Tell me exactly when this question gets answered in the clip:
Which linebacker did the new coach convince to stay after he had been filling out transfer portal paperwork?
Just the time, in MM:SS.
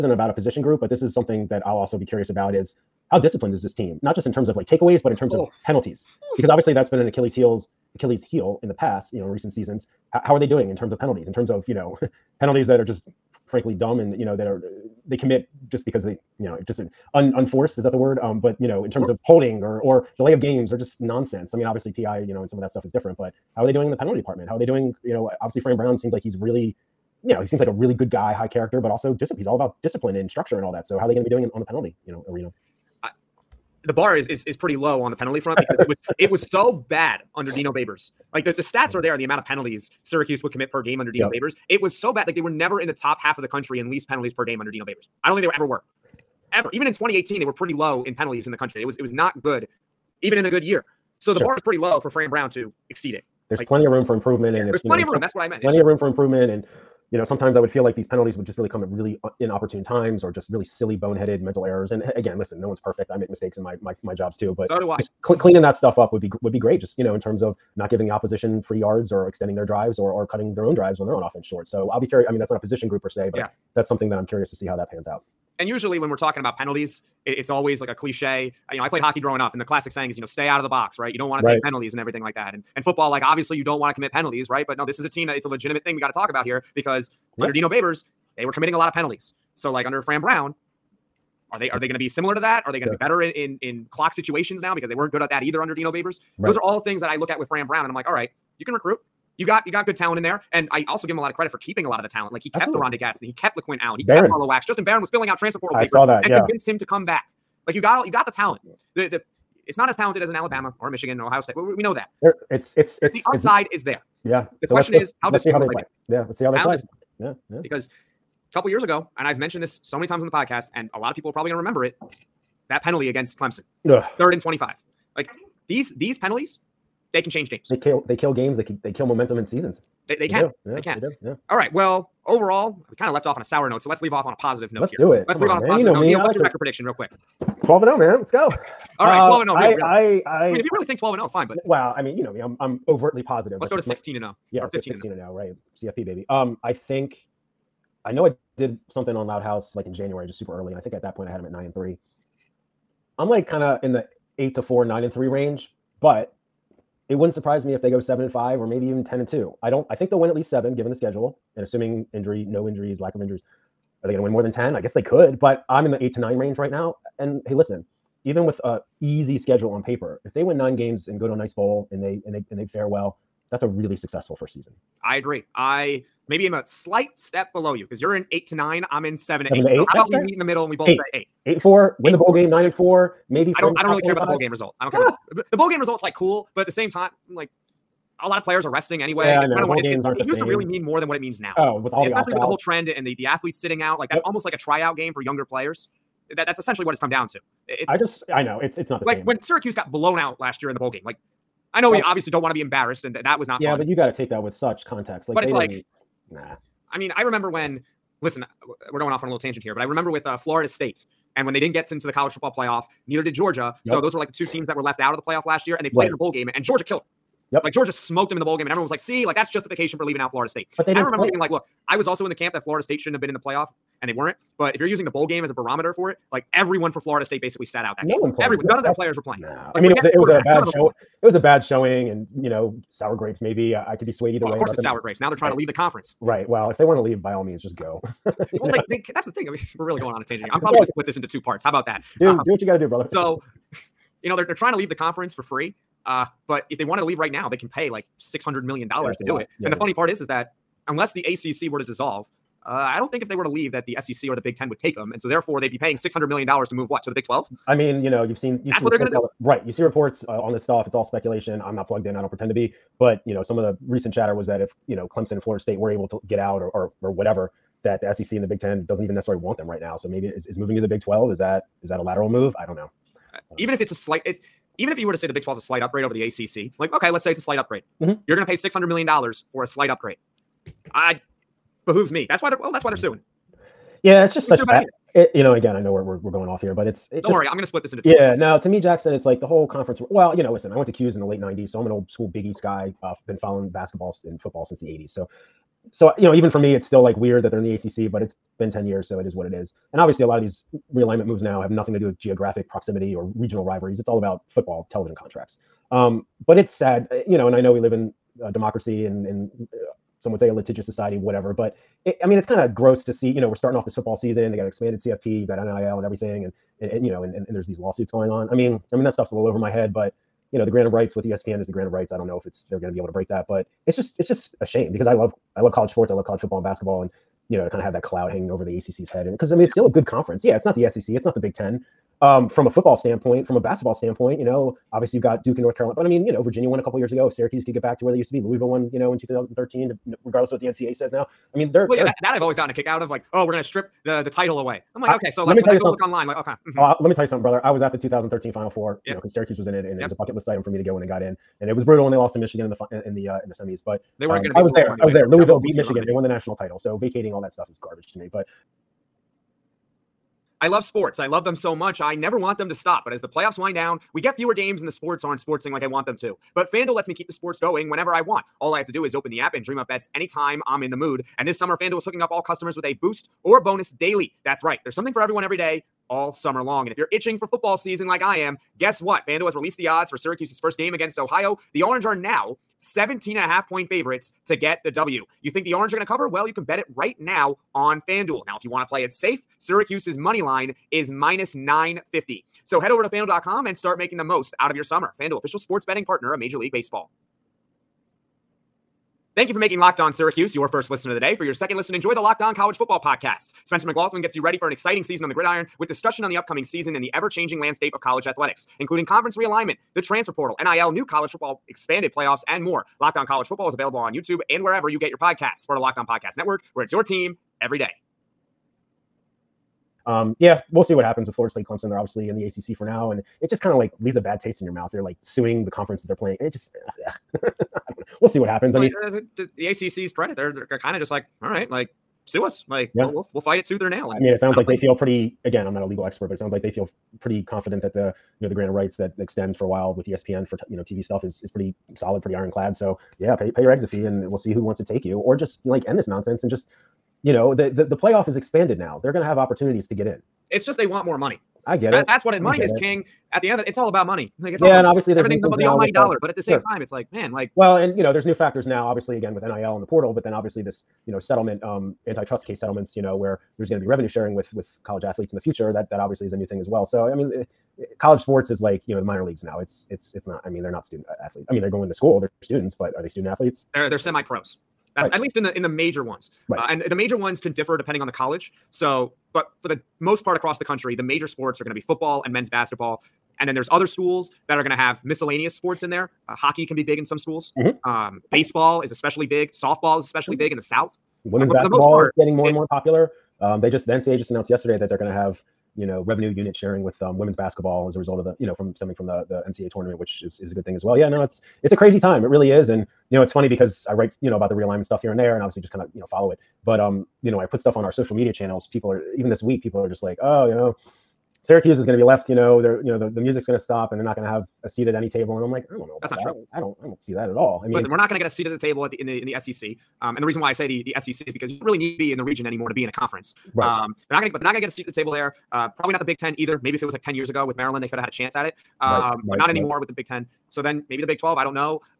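01:44.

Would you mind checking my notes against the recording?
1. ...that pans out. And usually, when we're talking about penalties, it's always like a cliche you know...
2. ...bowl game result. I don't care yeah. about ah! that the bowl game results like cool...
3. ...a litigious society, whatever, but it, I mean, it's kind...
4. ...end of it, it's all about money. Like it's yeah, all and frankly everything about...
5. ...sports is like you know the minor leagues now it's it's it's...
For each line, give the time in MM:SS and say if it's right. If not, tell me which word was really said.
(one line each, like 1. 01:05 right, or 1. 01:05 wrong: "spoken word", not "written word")
1. 01:14 right
2. 03:04 right
3. 05:10 right
4. 07:33 wrong: "obviously", not "frankly"
5. 07:48 right.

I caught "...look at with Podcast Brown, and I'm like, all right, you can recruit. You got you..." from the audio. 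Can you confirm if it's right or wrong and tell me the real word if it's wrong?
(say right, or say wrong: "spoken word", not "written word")
wrong: "Fran", not "Podcast".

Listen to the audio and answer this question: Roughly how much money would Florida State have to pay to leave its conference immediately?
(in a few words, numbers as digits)
$600 million.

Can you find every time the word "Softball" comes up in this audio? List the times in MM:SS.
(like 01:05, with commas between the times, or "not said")
08:09.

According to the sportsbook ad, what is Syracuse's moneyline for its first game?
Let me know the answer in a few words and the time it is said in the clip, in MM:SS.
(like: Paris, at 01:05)
-950, at 06:31.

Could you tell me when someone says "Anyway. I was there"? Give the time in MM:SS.
05:54.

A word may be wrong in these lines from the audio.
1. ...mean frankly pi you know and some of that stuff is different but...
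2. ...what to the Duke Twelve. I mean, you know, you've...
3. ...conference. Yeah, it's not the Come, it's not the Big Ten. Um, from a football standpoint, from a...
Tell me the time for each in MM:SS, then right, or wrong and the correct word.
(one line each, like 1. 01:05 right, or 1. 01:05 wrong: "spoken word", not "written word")
1. 00:21 wrong: "obviously", not "frankly"
2. 04:16 wrong: "Big", not "Duke"
3. 05:30 wrong: "SEC", not "Come".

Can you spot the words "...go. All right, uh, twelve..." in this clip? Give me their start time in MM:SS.
02:18.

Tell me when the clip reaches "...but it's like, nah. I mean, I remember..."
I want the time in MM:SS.
03:25.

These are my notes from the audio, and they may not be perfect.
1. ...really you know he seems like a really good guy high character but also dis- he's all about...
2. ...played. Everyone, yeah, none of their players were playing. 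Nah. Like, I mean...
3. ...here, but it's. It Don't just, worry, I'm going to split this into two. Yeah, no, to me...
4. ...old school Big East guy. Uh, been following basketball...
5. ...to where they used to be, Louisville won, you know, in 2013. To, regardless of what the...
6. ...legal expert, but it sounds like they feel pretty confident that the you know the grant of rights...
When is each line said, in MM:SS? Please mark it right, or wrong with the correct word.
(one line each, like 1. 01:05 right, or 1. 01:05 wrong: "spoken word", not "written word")
1. 00:26 right
2. 03:48 right
3. 04:46 right
4. 04:51 right
5. 05:37 right
6. 07:15 right.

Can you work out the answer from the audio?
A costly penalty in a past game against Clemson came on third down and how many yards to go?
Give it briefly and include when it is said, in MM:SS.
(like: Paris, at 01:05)
25, at 02:04.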